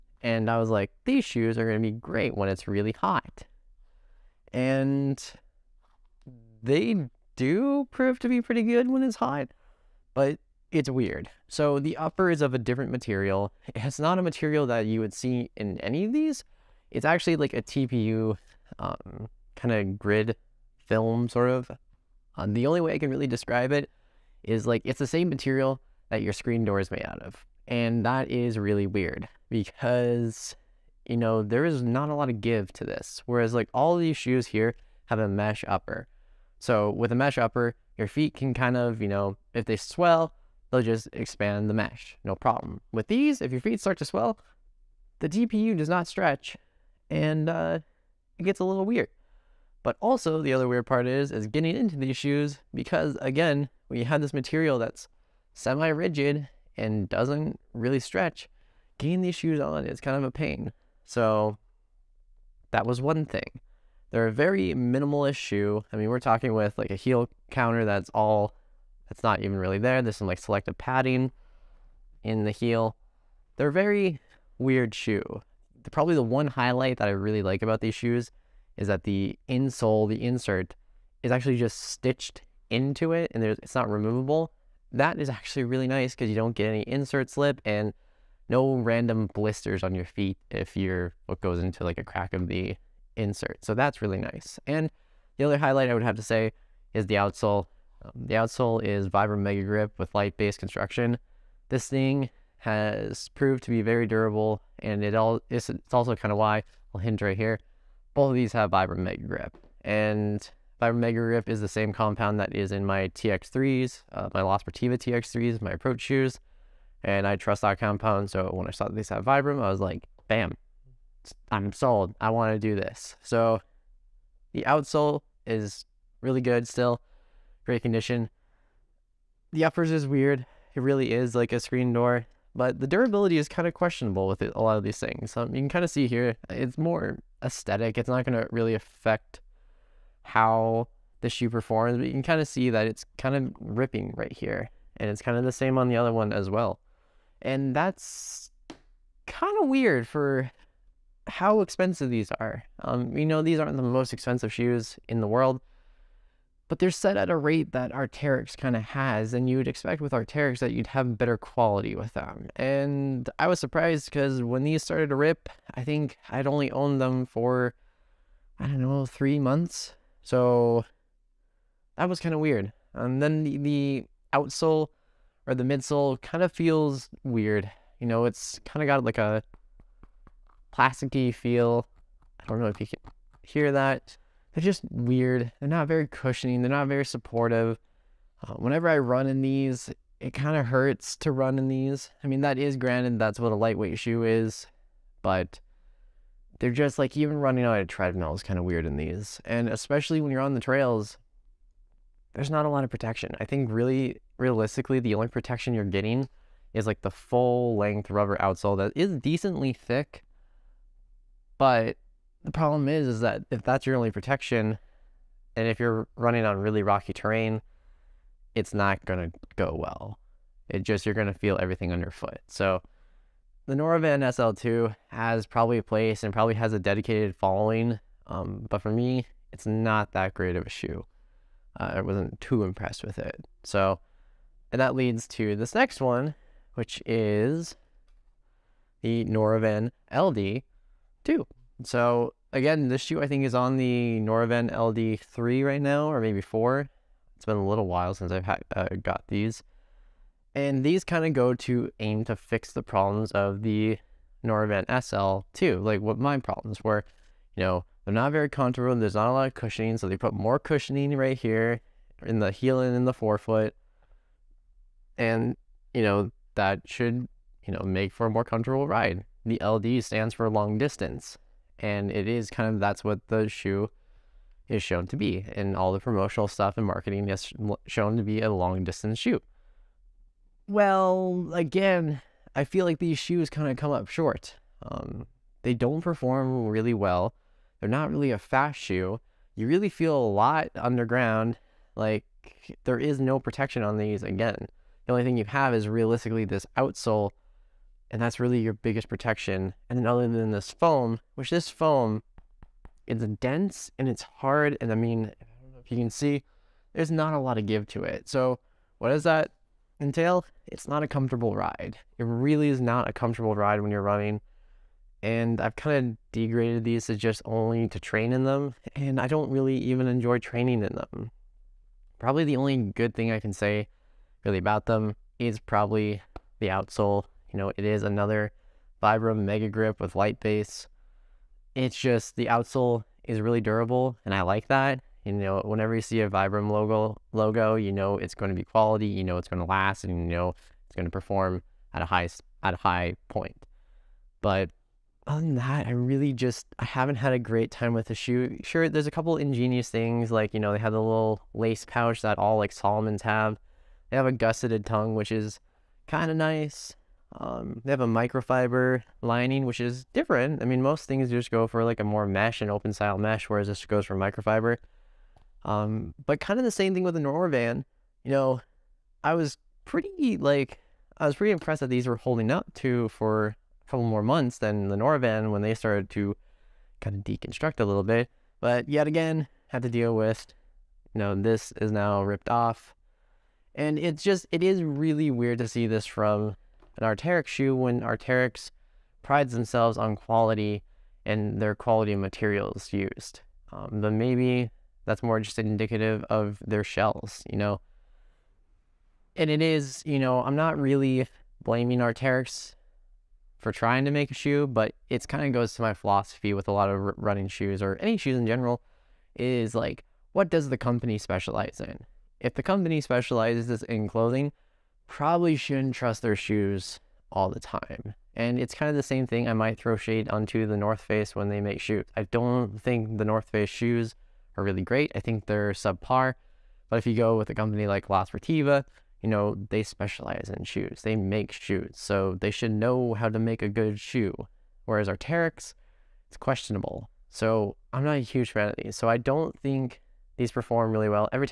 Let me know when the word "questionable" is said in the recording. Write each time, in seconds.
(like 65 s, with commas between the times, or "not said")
133 s, 436 s.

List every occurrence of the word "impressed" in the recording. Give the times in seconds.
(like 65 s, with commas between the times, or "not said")
232 s, 371 s.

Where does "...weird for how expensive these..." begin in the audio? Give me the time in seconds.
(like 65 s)
149 s.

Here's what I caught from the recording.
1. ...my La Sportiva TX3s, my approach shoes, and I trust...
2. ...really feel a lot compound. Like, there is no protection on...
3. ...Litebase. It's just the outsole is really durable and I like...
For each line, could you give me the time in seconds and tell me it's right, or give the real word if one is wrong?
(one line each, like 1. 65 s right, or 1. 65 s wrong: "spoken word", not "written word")
1. 114 s right
2. 289 s wrong: "underground", not "compound"
3. 330 s right.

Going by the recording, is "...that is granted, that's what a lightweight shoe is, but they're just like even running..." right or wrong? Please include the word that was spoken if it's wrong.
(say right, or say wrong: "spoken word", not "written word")
right.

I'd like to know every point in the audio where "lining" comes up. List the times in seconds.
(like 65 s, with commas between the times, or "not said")
359 s.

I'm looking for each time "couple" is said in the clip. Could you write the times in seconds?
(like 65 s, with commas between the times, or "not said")
349 s, 373 s.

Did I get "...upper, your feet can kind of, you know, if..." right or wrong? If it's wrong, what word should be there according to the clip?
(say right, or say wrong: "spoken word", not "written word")
right.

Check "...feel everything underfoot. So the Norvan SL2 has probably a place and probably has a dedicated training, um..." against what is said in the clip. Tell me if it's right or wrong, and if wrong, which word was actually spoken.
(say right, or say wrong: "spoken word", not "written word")
wrong: "following", not "training".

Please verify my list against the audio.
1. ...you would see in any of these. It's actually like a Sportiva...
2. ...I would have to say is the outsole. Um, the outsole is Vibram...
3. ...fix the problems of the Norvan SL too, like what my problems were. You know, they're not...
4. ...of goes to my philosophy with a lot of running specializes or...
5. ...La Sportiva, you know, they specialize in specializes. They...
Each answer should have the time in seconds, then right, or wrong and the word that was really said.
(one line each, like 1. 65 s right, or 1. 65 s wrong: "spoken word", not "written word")
1. 14 s wrong: "TPU", not "Sportiva"
2. 95 s right
3. 252 s right
4. 405 s wrong: "shoes", not "specializes"
5. 428 s wrong: "shoes", not "specializes".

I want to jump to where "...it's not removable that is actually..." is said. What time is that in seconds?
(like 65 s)
83 s.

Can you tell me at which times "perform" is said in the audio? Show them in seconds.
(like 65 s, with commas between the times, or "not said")
141 s, 286 s, 341 s, 440 s.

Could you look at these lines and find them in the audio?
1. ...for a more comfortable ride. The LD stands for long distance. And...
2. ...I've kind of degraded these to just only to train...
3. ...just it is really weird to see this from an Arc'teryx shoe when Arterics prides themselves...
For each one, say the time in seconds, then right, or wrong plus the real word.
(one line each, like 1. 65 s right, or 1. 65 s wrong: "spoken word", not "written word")
1. 268 s right
2. 315 s right
3. 384 s right.